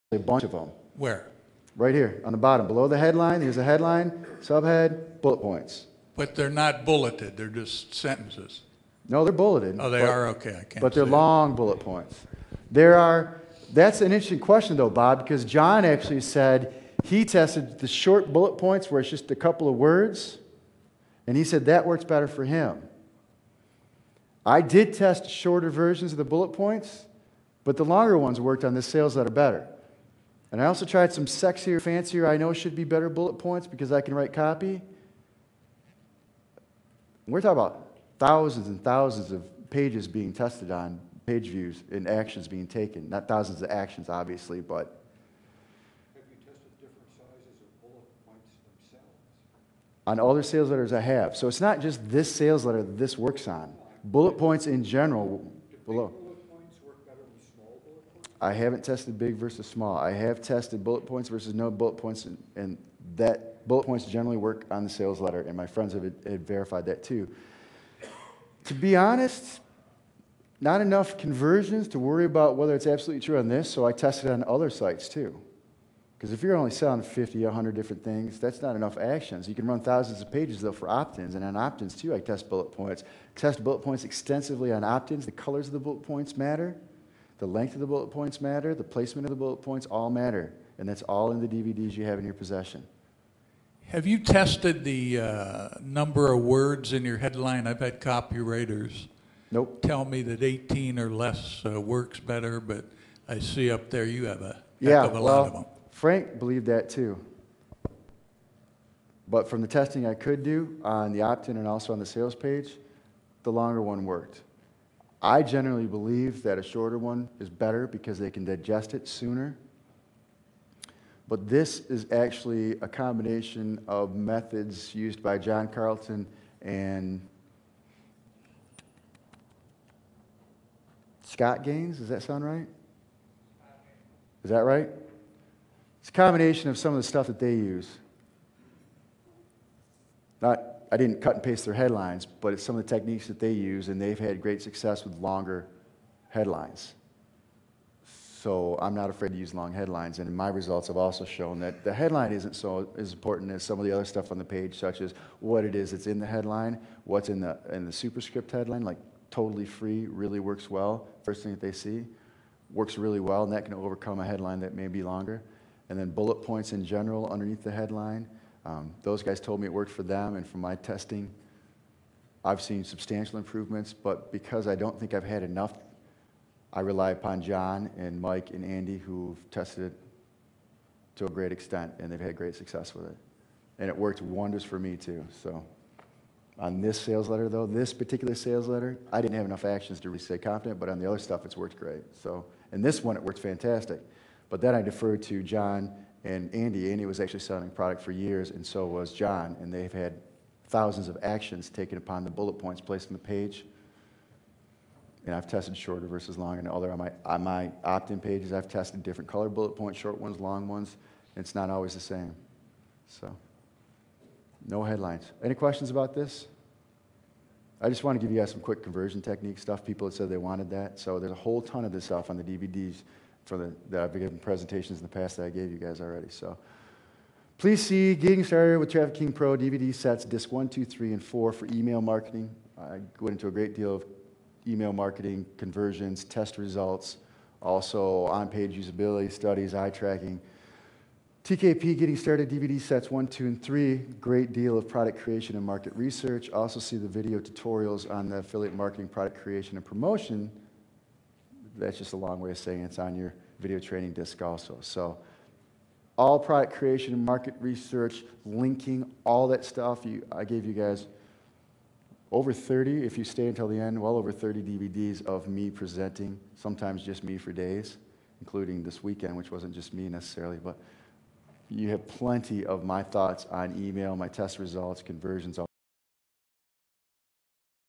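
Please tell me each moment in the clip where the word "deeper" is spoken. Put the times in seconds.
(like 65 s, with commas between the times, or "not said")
not said.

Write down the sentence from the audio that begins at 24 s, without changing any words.
I did test shorter versions of the bullet points, but the longer ones worked on the sales letter better.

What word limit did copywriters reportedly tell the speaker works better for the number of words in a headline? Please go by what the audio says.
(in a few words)
18 or less.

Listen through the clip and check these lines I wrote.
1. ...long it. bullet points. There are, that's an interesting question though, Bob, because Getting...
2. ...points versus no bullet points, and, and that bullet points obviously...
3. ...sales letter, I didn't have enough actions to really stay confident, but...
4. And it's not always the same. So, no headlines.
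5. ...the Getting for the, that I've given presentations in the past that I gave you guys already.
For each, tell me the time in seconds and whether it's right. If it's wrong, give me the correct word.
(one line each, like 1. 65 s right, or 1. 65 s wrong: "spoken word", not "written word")
1. 11 s wrong: "John", not "Getting"
2. 61 s wrong: "generally", not "obviously"
3. 188 s right
4. 211 s right
5. 222 s wrong: "DVDs", not "Getting".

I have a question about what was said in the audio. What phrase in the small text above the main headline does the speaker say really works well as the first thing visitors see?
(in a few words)
totally free.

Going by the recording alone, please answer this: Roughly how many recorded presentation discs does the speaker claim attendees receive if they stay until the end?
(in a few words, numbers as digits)
over 30.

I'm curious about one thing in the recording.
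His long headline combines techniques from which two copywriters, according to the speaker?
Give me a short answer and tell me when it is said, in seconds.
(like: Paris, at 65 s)
John Carlton and Scott Gaines, at 125 s.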